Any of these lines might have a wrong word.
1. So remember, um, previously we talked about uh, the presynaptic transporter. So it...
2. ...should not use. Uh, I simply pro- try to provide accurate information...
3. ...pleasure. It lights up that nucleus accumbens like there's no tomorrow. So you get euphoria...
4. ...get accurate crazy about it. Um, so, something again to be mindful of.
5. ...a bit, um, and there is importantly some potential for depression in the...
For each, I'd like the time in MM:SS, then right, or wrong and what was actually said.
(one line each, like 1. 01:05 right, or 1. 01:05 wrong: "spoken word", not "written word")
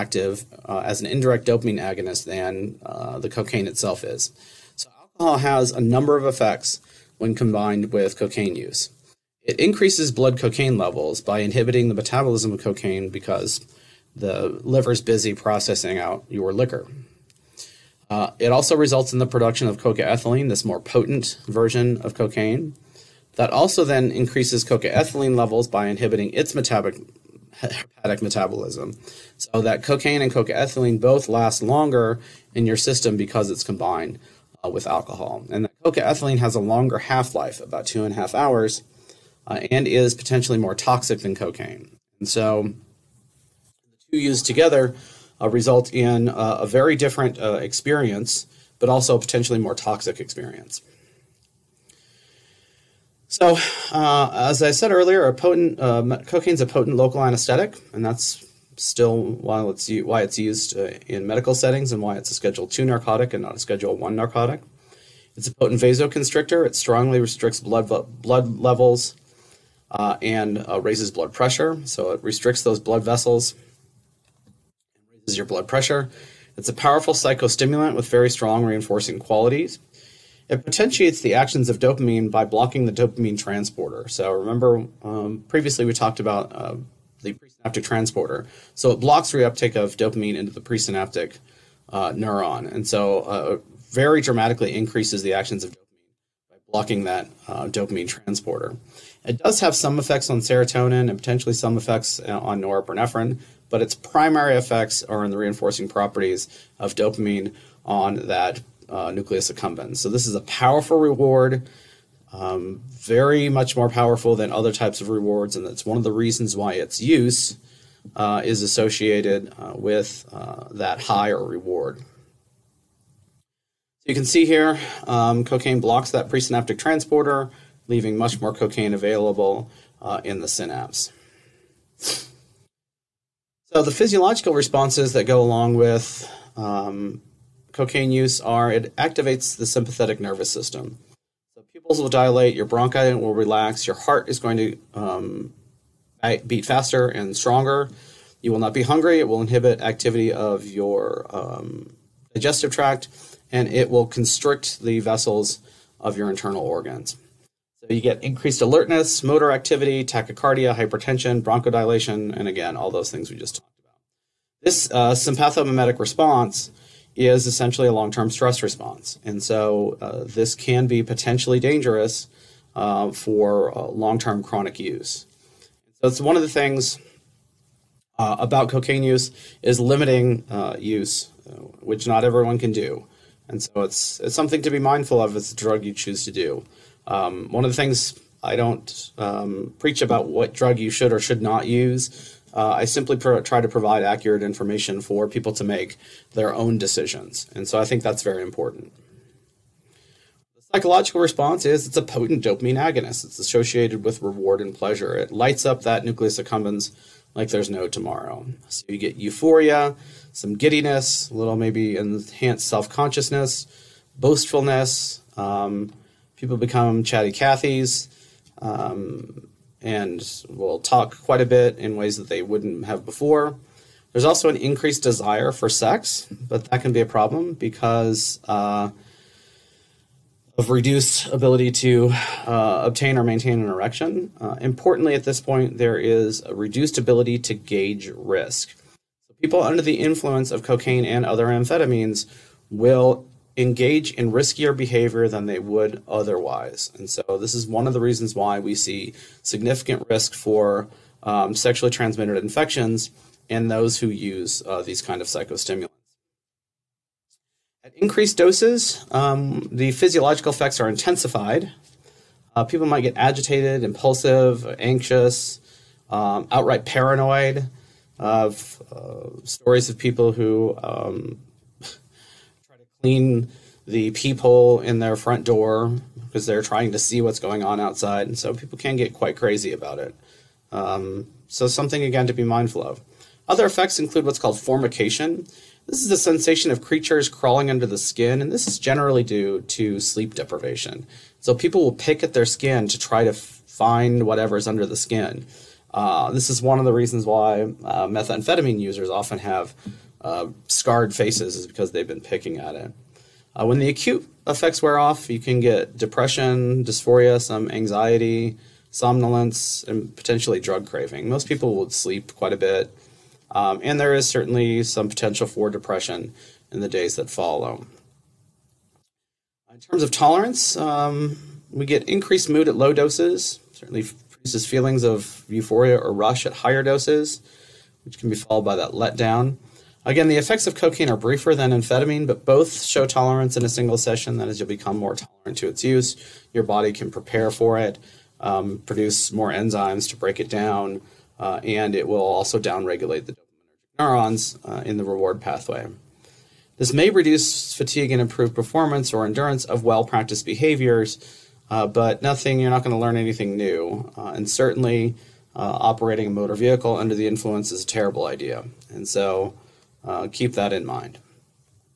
1. 01:24 right
2. 03:11 right
3. 03:24 right
4. 04:38 wrong: "quite", not "accurate"
5. 05:12 wrong: "certainly", not "importantly".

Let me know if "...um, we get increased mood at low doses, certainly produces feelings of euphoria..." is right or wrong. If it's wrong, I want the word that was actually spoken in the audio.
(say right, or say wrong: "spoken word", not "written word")
right.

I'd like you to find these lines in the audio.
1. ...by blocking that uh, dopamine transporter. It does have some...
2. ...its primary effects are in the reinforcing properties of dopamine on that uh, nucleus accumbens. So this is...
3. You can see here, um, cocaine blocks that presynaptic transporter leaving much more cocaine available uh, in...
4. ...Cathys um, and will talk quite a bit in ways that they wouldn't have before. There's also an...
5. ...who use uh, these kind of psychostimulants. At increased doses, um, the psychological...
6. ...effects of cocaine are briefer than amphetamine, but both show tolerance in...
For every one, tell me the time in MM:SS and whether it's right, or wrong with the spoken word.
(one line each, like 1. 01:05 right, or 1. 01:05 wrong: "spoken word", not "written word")
1. 01:36 right
2. 01:43 right
3. 02:04 right
4. 03:37 right
5. 04:13 wrong: "physiological", not "psychological"
6. 05:30 right.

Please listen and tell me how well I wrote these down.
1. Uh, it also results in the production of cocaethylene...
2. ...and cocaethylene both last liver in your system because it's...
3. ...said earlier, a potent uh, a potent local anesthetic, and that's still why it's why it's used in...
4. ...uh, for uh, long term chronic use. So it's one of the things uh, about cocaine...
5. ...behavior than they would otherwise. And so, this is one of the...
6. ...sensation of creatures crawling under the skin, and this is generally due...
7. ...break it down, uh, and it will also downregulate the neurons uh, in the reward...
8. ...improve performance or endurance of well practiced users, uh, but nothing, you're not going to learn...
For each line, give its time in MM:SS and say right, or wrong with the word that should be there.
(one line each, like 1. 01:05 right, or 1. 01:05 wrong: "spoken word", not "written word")
1. 00:18 right
2. 00:30 wrong: "longer", not "liver"
3. 00:54 right
4. 02:52 right
5. 04:04 right
6. 04:46 right
7. 05:40 right
8. 05:48 wrong: "behaviors", not "users".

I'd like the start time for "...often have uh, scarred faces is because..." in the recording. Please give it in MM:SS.
04:59.